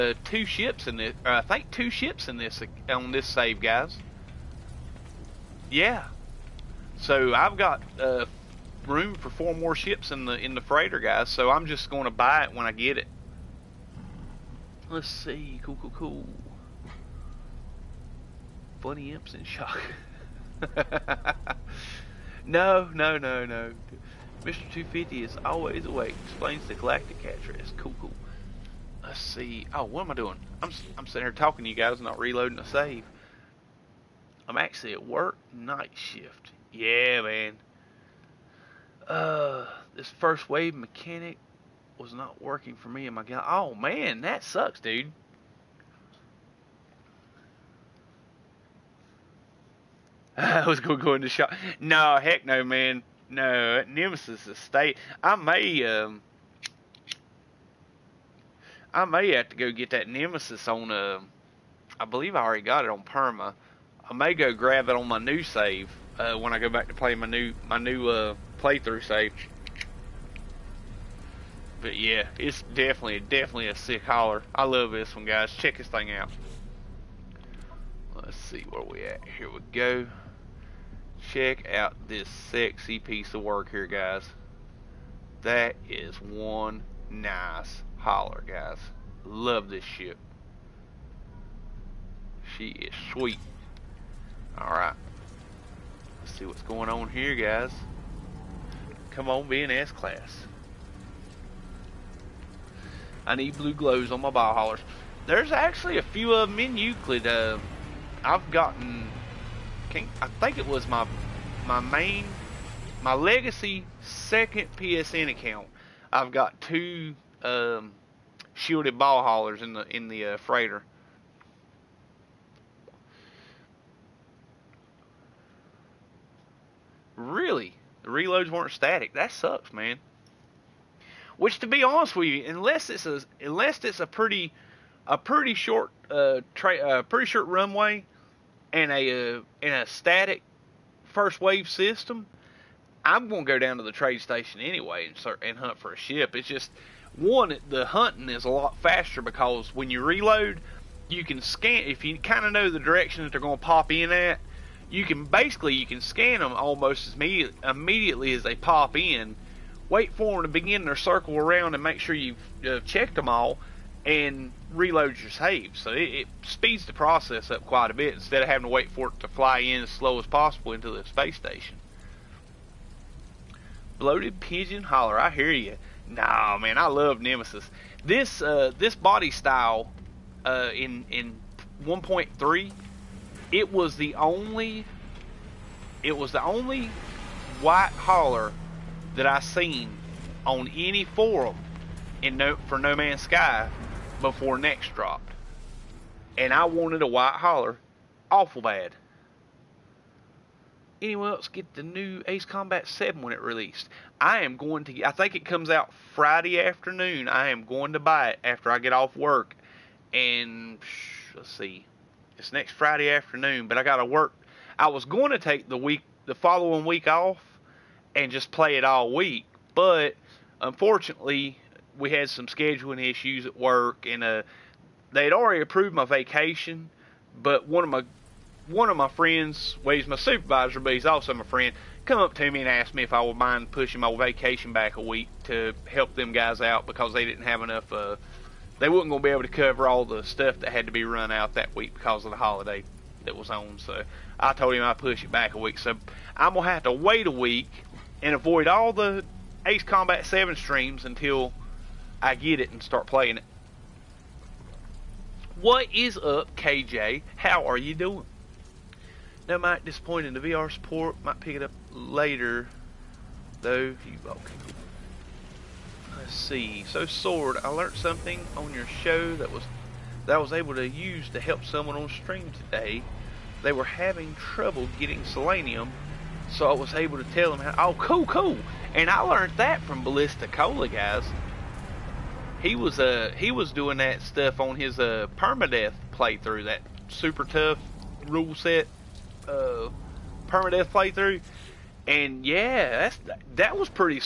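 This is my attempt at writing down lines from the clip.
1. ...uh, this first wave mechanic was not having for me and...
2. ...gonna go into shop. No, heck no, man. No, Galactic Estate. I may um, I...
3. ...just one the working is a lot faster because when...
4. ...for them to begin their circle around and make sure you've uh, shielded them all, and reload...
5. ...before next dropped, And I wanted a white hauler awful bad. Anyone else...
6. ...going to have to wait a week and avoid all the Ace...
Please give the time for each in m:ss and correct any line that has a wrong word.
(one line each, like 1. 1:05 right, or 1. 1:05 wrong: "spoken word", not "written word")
1. 0:39 wrong: "working", not "having"
2. 0:50 wrong: "Nemesis", not "Galactic"
3. 2:26 wrong: "hunting", not "working"
4. 2:40 wrong: "checked", not "shielded"
5. 3:14 right
6. 4:06 right.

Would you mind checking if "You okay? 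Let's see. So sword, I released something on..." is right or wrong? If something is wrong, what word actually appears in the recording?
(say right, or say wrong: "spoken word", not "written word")
wrong: "learned", not "released".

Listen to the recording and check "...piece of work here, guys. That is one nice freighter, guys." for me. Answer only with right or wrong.
wrong.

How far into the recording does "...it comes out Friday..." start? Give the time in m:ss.
3:25.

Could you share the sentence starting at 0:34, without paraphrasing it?
I'm actually at work, night shift.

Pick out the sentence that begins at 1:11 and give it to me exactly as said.
But yeah, it's definitely, definitely a sick hauler.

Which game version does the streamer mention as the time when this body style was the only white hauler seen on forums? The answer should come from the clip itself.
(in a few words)
1.3.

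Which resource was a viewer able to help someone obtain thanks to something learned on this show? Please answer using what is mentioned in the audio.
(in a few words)
Selenium.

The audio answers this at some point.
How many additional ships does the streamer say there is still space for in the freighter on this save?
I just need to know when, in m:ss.
0:09.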